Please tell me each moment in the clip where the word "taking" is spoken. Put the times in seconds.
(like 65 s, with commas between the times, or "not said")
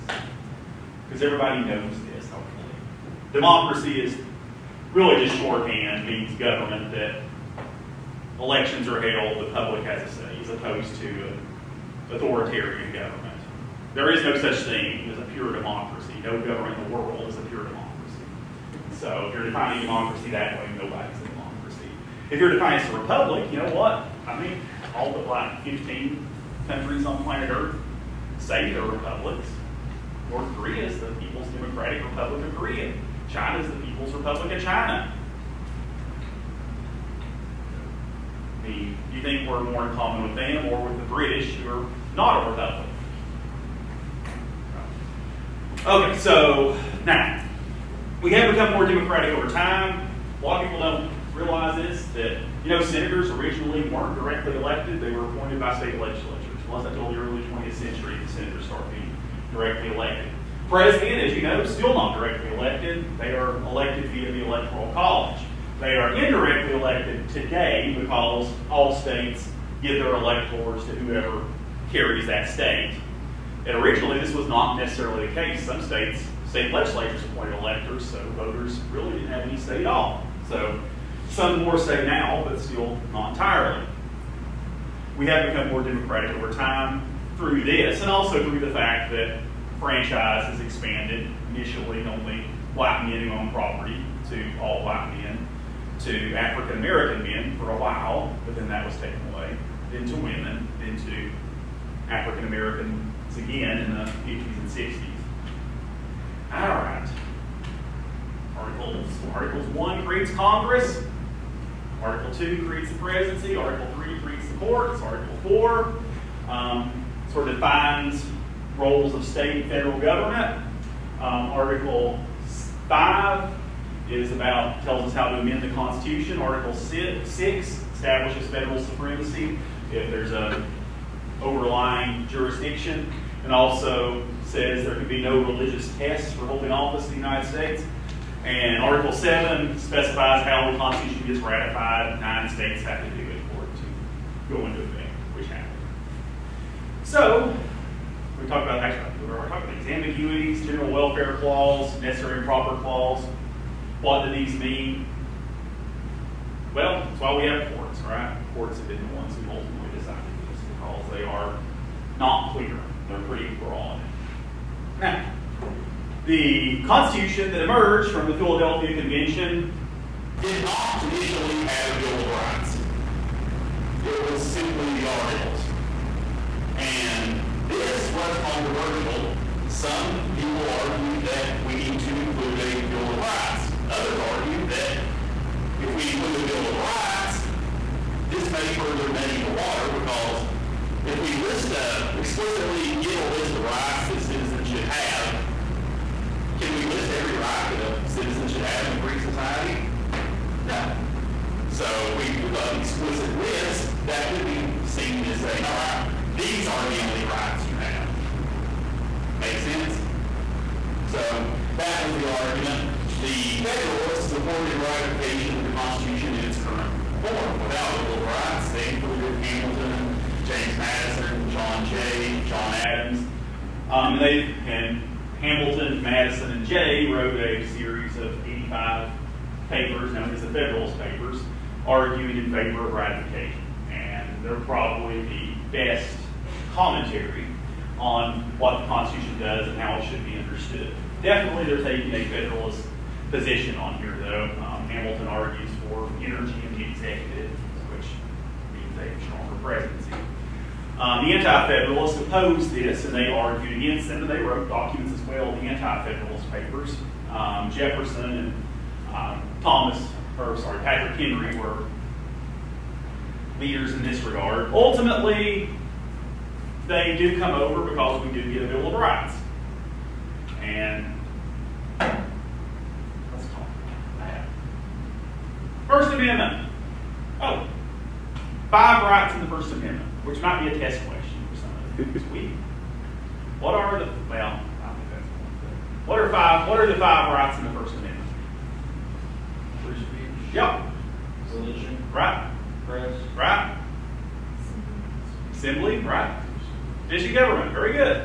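241 s.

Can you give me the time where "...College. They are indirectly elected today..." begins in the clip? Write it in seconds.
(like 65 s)
64 s.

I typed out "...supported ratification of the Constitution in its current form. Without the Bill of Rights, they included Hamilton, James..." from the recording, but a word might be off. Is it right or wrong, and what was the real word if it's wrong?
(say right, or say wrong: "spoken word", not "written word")
right.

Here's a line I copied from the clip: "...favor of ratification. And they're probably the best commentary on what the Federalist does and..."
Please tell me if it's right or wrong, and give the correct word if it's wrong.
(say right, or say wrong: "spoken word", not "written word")
wrong: "Constitution", not "Federalist".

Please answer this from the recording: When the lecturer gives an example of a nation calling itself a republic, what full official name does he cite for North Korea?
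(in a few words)
People's Democratic Republic of Korea.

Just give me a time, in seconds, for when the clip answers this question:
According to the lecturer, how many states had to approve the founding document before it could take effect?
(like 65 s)
142 s.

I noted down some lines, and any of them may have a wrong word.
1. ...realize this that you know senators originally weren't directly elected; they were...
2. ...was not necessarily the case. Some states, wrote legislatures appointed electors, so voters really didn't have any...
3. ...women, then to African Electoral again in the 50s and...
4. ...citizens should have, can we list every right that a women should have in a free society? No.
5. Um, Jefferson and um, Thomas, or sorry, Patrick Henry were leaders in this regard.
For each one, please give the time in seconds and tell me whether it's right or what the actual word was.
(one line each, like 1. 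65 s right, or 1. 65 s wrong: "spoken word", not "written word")
1. 51 s right
2. 74 s wrong: "state", not "wrote"
3. 100 s wrong: "Americans", not "Electoral"
4. 194 s wrong: "citizen", not "women"
5. 257 s right.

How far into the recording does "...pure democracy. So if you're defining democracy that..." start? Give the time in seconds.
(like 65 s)
17 s.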